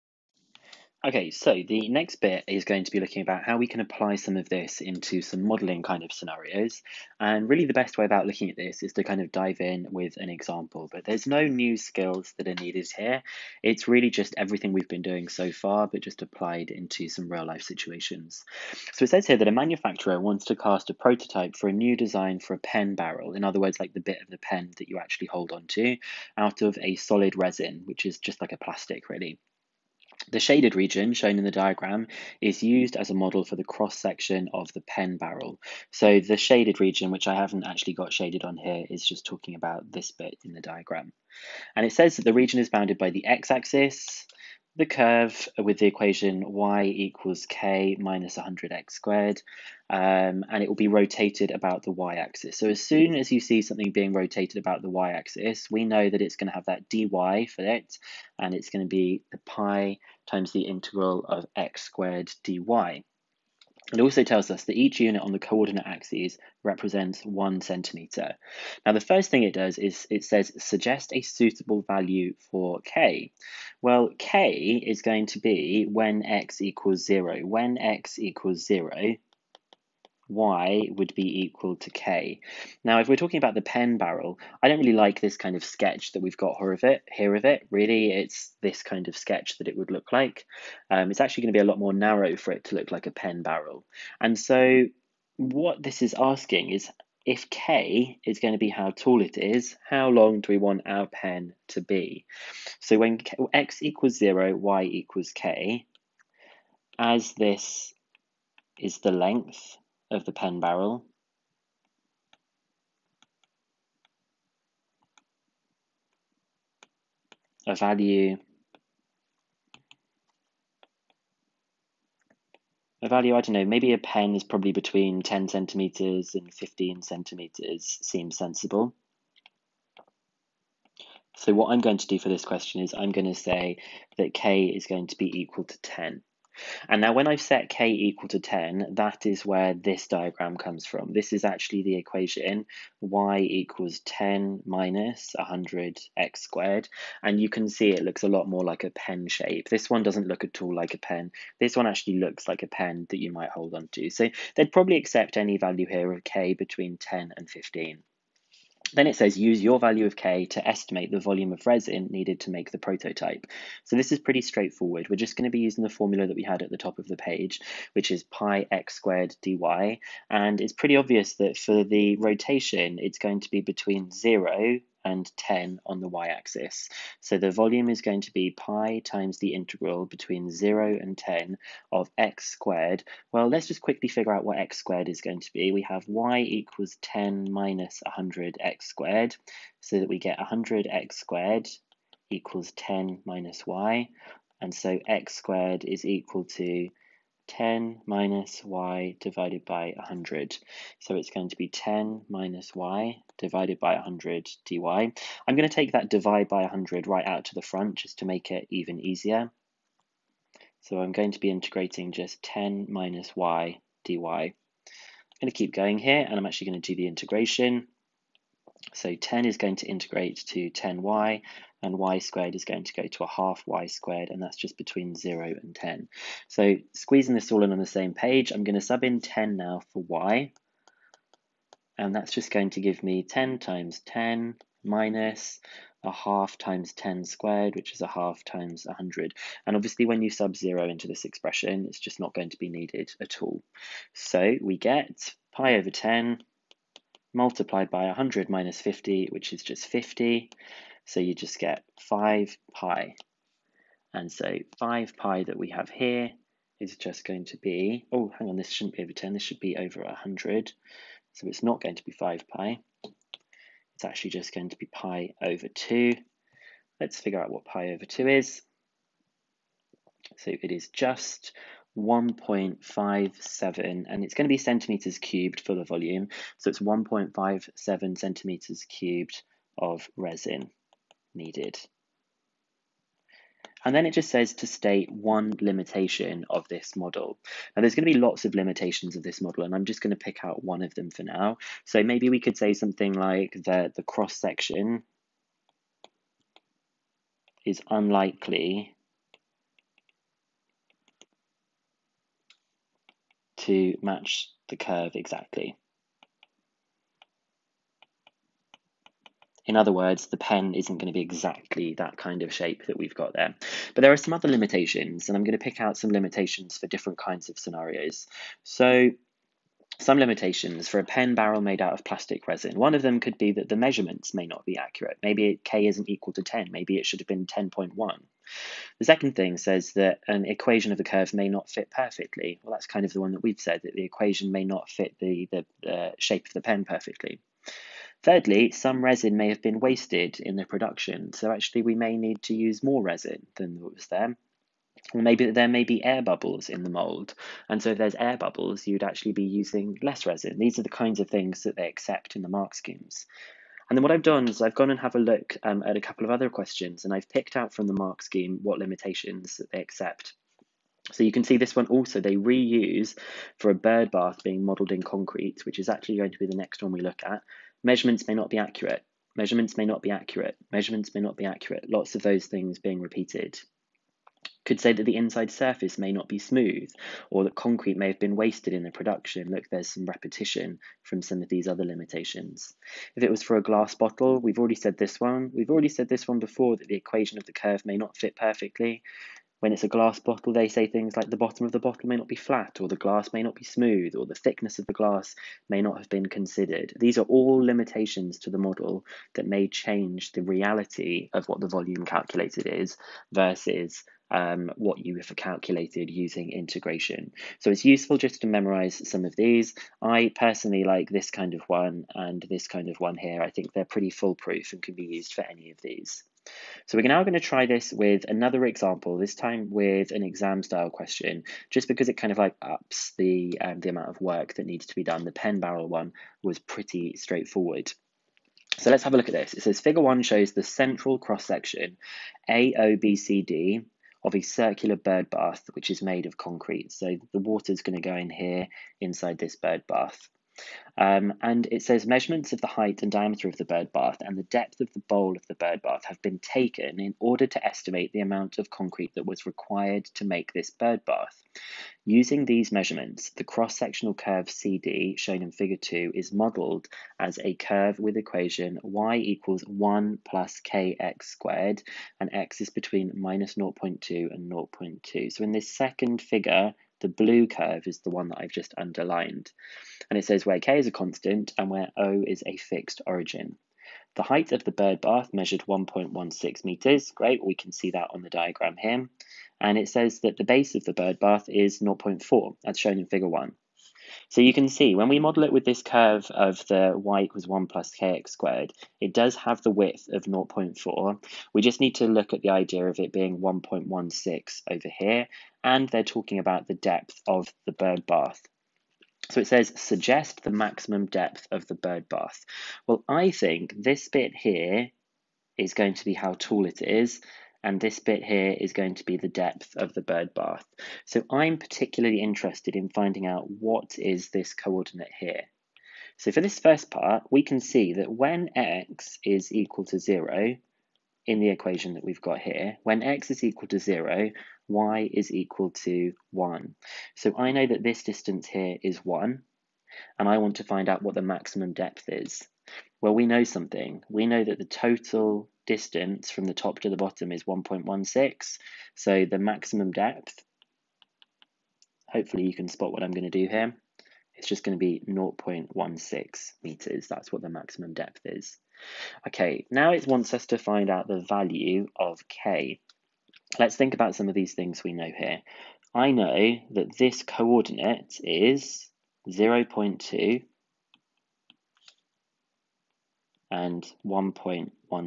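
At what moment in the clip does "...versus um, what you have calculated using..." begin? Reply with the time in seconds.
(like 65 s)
403 s.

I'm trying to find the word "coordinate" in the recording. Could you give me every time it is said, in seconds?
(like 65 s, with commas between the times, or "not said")
65 s, 514 s, 557 s.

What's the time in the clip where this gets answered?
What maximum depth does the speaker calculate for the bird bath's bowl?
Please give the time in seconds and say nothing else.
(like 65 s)
545 s.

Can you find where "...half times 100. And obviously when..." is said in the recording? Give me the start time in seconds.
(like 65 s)
238 s.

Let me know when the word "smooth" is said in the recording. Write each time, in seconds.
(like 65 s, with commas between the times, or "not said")
376 s, 393 s.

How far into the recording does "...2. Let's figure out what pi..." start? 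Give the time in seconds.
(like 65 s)
265 s.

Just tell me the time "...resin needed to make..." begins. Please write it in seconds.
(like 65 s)
161 s.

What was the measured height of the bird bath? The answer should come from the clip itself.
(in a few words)
1.16 meters.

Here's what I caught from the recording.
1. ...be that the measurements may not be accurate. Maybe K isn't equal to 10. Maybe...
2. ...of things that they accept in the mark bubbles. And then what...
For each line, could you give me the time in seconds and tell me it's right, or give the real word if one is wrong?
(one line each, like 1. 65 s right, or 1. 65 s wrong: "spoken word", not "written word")
1. 323 s right
2. 351 s wrong: "schemes", not "bubbles".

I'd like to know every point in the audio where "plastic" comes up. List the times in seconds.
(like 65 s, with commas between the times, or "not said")
28 s, 322 s.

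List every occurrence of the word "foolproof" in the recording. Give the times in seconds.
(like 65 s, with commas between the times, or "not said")
414 s.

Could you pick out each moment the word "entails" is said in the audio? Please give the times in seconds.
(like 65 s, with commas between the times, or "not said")
not said.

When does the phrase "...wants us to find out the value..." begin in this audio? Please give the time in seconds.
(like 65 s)
550 s.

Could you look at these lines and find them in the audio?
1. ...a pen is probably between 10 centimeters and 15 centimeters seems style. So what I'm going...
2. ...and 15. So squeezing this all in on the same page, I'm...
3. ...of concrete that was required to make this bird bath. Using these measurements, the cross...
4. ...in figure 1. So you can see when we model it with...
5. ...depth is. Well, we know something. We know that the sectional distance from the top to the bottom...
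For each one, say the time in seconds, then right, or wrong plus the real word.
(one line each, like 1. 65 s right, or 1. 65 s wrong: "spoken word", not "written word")
1. 123 s wrong: "sensible", not "style"
2. 225 s wrong: "10", not "15"
3. 448 s right
4. 482 s right
5. 531 s wrong: "total", not "sectional".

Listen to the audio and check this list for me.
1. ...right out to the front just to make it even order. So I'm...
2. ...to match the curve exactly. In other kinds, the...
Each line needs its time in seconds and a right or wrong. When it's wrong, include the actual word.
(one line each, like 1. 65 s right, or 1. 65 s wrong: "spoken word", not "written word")
1. 207 s wrong: "easier", not "order"
2. 303 s wrong: "words", not "kinds".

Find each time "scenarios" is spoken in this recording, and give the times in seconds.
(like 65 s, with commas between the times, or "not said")
6 s, 317 s.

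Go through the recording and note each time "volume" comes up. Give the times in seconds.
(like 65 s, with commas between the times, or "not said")
161 s, 177 s, 275 s, 401 s.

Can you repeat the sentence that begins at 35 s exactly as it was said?
So the shaded region, which I haven't actually got shaded on here, is just talking about this bit in the diagram.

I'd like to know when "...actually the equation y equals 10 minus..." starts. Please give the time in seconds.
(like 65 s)
141 s.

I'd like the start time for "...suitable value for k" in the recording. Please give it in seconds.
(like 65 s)
71 s.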